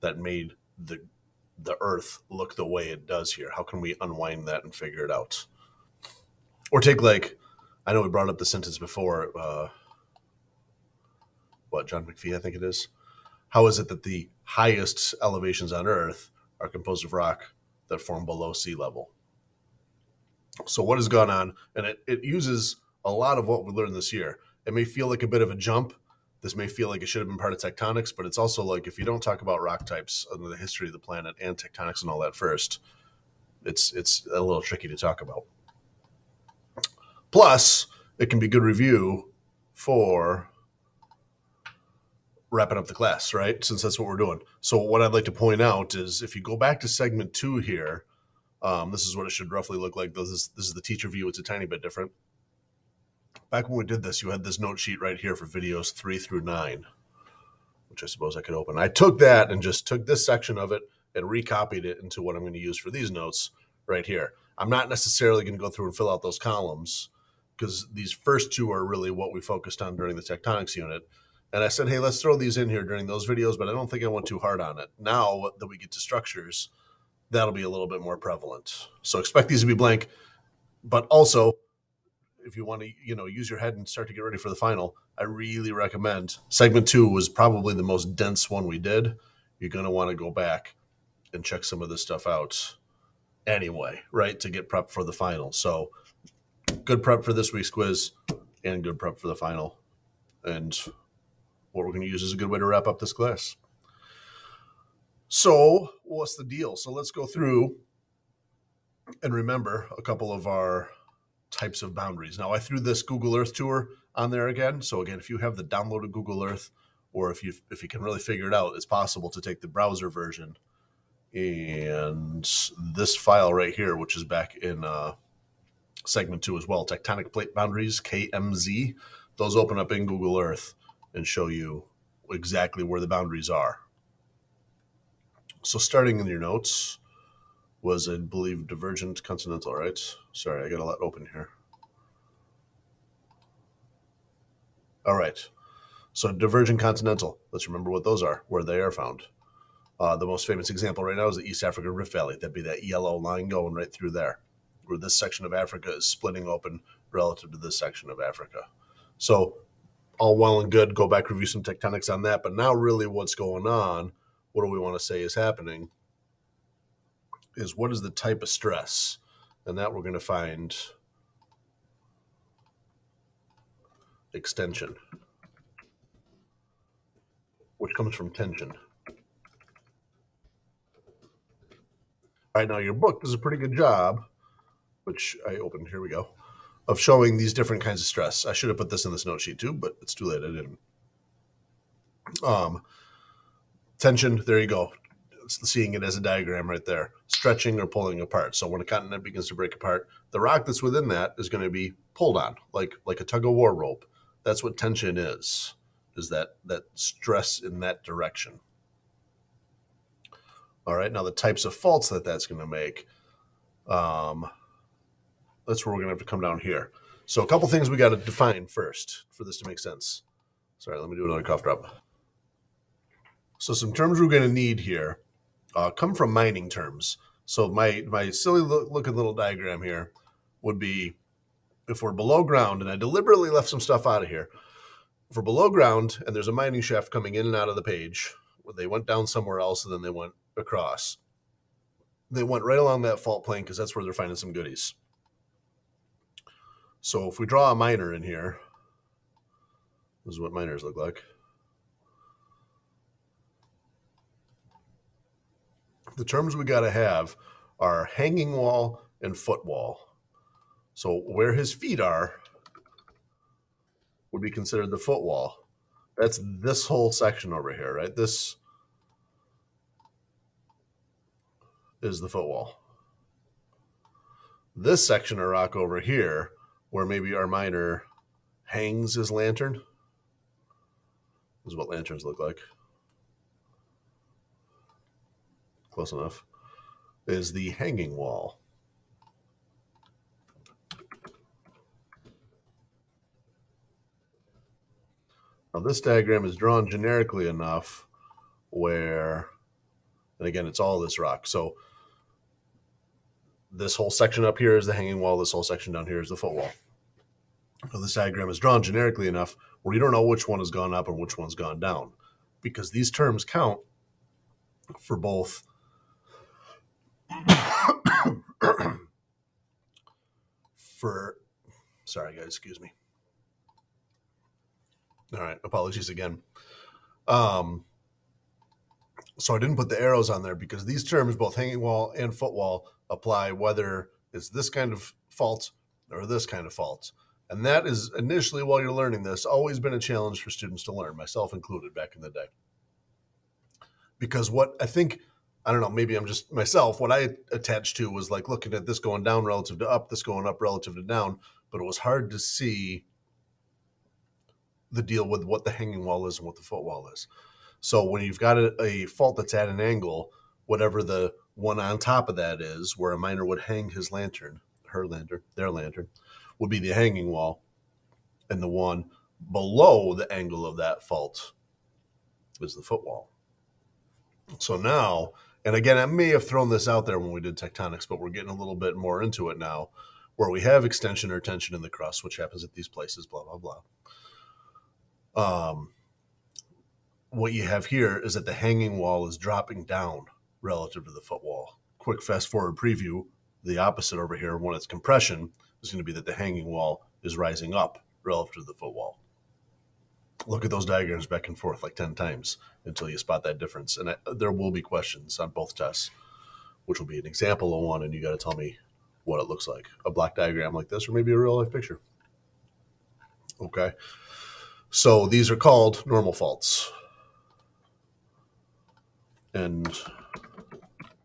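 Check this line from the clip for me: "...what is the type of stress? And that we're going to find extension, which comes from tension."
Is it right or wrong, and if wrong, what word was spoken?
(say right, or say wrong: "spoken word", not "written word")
right.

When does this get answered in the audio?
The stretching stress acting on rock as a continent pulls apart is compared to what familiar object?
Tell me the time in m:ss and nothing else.
3:23.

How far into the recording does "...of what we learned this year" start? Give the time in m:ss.
0:23.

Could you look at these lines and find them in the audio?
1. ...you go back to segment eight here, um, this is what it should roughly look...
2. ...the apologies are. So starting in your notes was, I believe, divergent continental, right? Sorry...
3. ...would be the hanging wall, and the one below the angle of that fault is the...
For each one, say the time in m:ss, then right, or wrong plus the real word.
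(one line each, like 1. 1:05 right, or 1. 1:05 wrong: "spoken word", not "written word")
1. 0:46 wrong: "two", not "eight"
2. 2:13 wrong: "boundaries", not "apologies"
3. 6:06 right.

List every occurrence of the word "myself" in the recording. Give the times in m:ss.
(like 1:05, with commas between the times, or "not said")
5:41, 5:46.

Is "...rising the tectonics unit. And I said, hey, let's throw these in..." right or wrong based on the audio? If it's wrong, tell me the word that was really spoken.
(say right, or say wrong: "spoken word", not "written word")
wrong: "during", not "rising".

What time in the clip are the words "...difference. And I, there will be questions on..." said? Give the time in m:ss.
6:43.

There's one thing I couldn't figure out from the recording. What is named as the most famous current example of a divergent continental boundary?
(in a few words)
East Africa Rift Valley.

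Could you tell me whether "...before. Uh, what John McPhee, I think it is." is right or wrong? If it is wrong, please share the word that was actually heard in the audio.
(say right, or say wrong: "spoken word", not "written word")
right.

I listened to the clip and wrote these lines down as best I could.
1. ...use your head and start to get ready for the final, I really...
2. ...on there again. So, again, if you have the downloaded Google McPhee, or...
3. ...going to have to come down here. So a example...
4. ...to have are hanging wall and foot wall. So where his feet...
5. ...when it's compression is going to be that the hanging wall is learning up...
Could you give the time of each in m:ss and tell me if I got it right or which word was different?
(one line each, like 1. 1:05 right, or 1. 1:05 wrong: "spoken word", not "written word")
1. 1:23 right
2. 1:54 wrong: "Earth", not "McPhee"
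3. 3:36 wrong: "couple", not "example"
4. 4:16 right
5. 6:34 wrong: "rising", not "learning".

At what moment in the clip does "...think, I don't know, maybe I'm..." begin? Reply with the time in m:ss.
5:44.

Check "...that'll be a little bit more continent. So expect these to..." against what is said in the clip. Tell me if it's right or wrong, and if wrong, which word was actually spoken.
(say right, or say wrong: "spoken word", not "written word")
wrong: "prevalent", not "continent".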